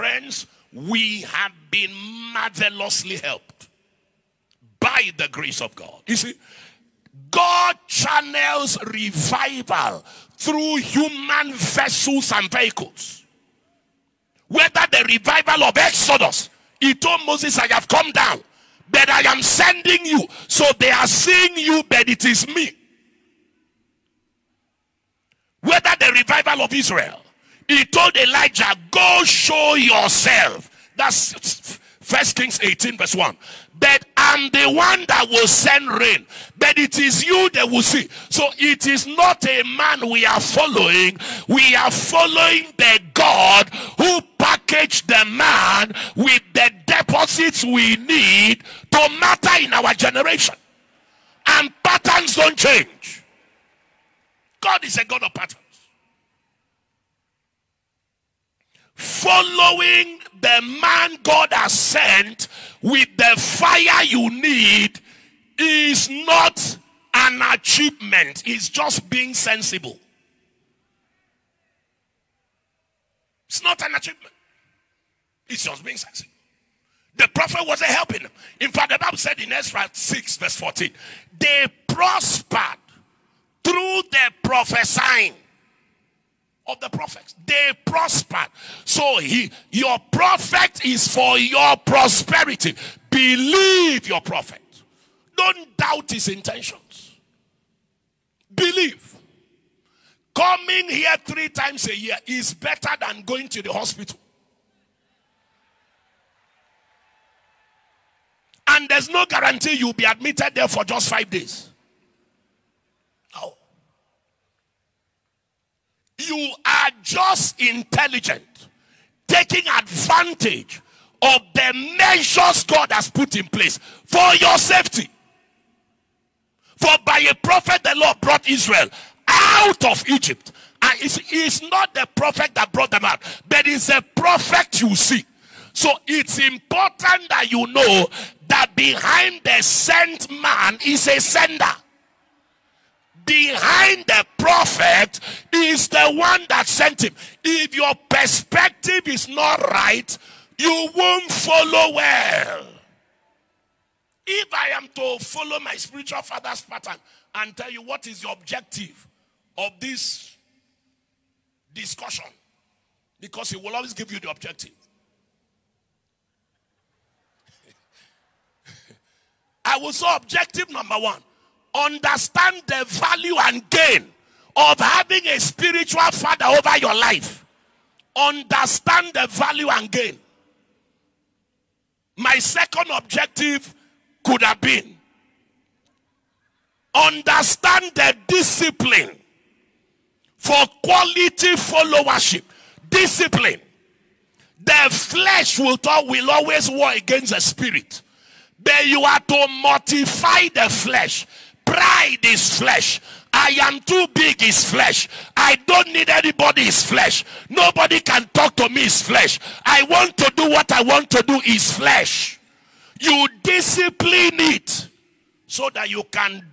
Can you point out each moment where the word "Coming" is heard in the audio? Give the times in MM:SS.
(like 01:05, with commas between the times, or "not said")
01:40.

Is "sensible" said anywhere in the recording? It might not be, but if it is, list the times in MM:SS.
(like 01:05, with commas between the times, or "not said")
01:09, 01:15.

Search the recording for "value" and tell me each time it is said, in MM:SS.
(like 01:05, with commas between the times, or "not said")
02:52, 02:59.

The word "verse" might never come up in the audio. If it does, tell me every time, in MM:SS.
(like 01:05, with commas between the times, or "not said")
00:32, 01:20.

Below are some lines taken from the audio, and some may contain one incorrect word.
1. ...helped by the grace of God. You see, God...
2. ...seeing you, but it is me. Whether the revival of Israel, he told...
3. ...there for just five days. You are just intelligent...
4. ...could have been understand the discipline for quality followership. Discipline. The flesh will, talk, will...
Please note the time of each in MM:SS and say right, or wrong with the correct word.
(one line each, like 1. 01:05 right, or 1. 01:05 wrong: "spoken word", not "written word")
1. 00:03 right
2. 00:21 right
3. 01:50 right
4. 03:04 right.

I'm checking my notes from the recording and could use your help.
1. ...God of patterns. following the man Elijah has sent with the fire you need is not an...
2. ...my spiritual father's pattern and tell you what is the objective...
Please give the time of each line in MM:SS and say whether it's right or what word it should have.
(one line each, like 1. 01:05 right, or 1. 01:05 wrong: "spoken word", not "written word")
1. 00:55 wrong: "God", not "Elijah"
2. 02:35 right.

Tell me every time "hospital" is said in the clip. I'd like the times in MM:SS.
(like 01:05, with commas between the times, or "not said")
01:43.